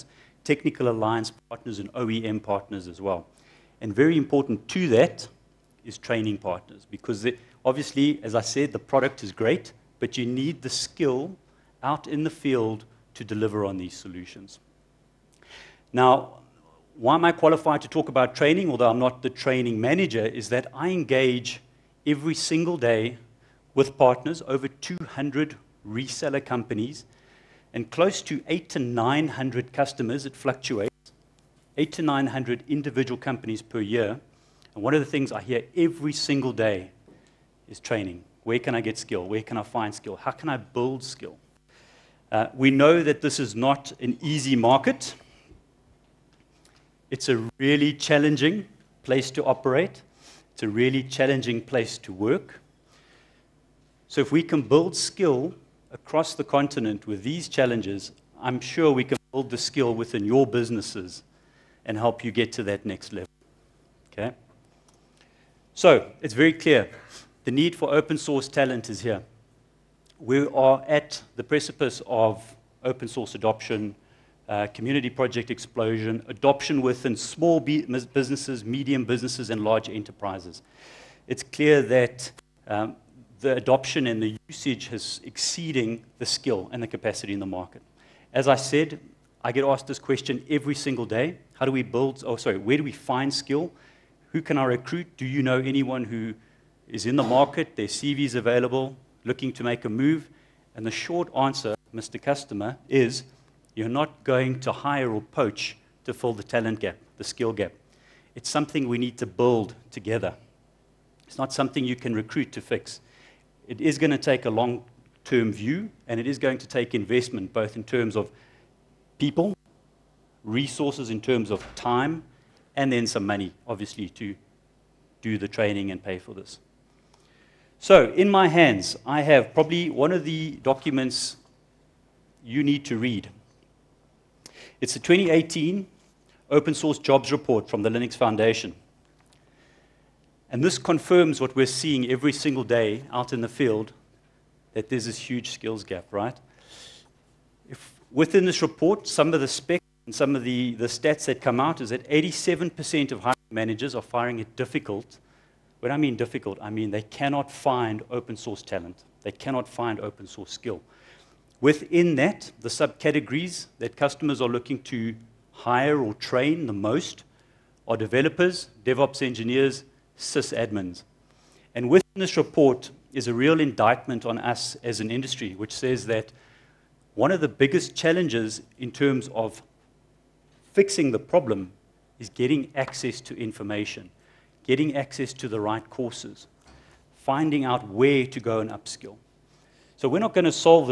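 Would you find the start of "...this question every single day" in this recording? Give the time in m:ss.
1:29.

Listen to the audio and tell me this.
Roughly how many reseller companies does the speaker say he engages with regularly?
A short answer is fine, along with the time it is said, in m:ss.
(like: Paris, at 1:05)
over 200, at 0:24.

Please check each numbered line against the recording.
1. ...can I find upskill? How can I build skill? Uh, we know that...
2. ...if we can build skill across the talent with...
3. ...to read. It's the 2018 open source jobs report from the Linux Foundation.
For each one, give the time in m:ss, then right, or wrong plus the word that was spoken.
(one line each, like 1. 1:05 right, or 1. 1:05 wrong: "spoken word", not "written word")
1. 0:39 wrong: "skill", not "upskill"
2. 0:54 wrong: "continent", not "talent"
3. 2:12 right.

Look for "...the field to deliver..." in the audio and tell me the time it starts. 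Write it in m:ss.
0:12.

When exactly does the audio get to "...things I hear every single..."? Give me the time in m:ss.
0:35.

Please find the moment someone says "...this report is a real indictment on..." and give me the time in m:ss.
2:52.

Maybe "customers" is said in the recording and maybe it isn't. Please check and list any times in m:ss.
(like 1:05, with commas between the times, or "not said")
0:29, 1:42, 2:43.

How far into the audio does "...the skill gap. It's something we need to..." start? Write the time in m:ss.
1:47.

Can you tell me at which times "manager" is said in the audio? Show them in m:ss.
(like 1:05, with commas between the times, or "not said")
0:19, 2:33.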